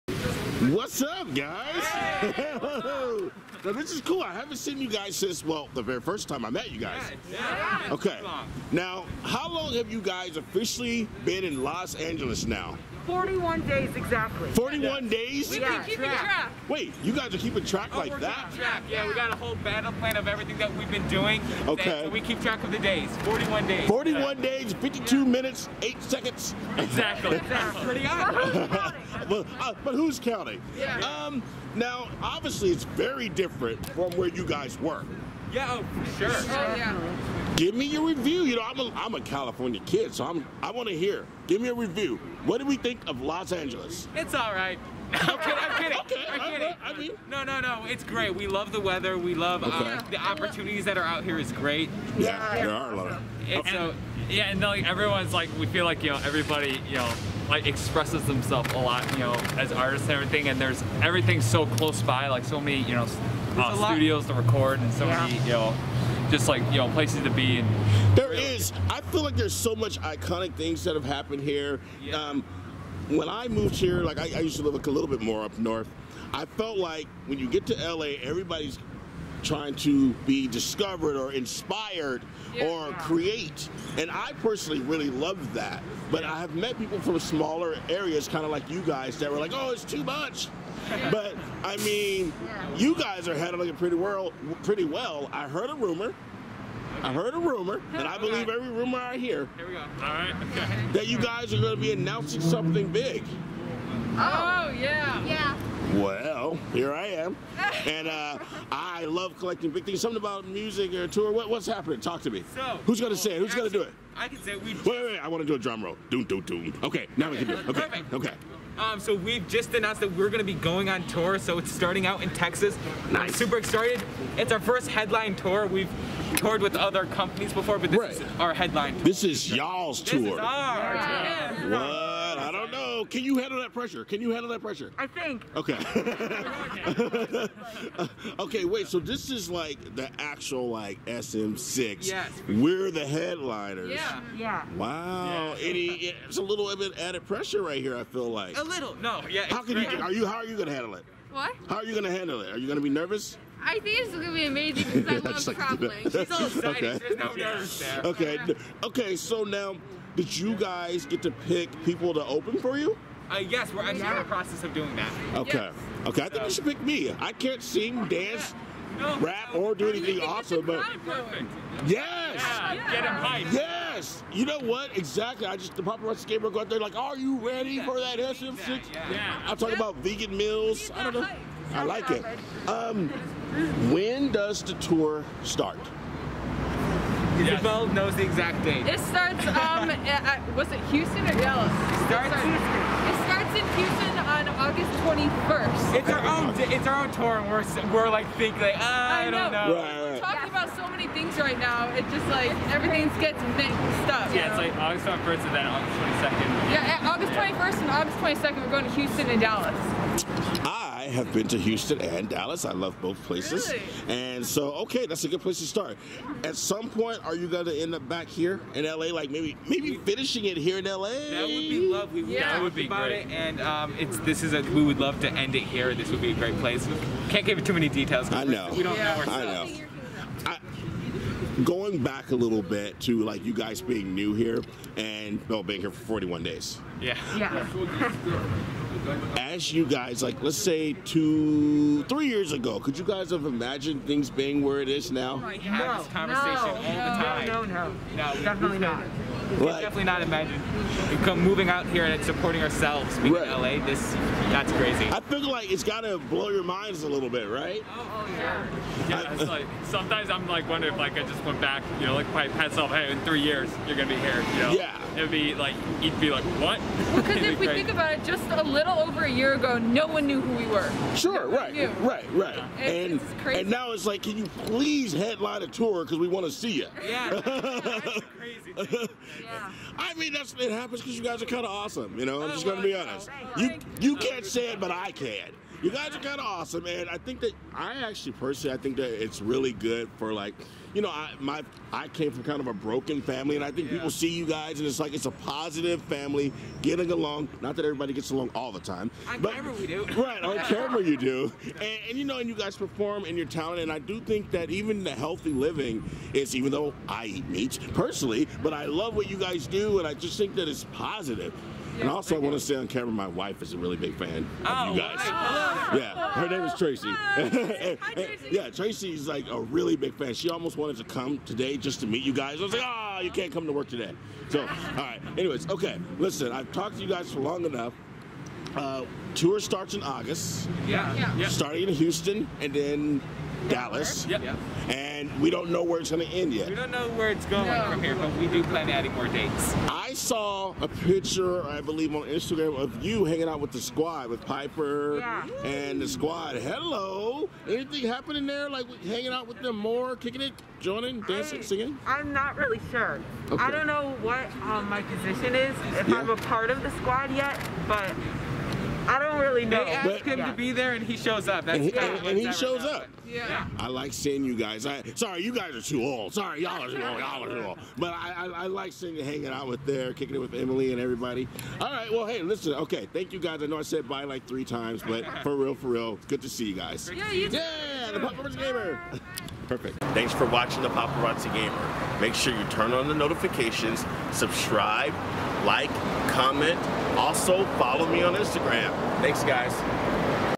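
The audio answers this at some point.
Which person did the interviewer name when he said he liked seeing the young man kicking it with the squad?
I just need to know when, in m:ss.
6:10.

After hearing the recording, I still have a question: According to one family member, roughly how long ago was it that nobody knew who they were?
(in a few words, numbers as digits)
a little over a year.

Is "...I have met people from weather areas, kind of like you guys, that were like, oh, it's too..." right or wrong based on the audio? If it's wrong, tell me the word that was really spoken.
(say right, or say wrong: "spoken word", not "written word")
wrong: "smaller", not "weather".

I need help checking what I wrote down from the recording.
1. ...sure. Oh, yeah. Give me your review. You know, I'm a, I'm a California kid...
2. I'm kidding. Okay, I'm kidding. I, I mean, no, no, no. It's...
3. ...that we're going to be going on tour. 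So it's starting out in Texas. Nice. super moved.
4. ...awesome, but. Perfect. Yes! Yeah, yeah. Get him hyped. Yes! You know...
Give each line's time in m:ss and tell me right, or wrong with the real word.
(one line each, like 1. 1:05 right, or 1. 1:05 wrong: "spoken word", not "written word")
1. 0:36 right
2. 0:45 right
3. 2:00 wrong: "excited", not "moved"
4. 2:50 right.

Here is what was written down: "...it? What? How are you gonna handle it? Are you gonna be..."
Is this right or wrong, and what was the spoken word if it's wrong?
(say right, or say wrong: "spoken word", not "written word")
right.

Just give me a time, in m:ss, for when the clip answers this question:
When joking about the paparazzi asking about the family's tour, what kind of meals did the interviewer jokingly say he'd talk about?
2:59.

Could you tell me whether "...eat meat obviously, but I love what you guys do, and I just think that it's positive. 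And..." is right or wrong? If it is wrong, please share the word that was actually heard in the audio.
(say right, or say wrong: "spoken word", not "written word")
wrong: "personally", not "obviously".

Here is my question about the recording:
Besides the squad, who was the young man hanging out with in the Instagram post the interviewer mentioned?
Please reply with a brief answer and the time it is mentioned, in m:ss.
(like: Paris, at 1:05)
Piper, at 5:44.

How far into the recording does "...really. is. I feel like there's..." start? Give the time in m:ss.
1:08.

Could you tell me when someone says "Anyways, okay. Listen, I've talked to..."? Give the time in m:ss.
5:25.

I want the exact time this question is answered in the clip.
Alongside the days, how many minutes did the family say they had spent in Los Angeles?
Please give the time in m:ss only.
0:24.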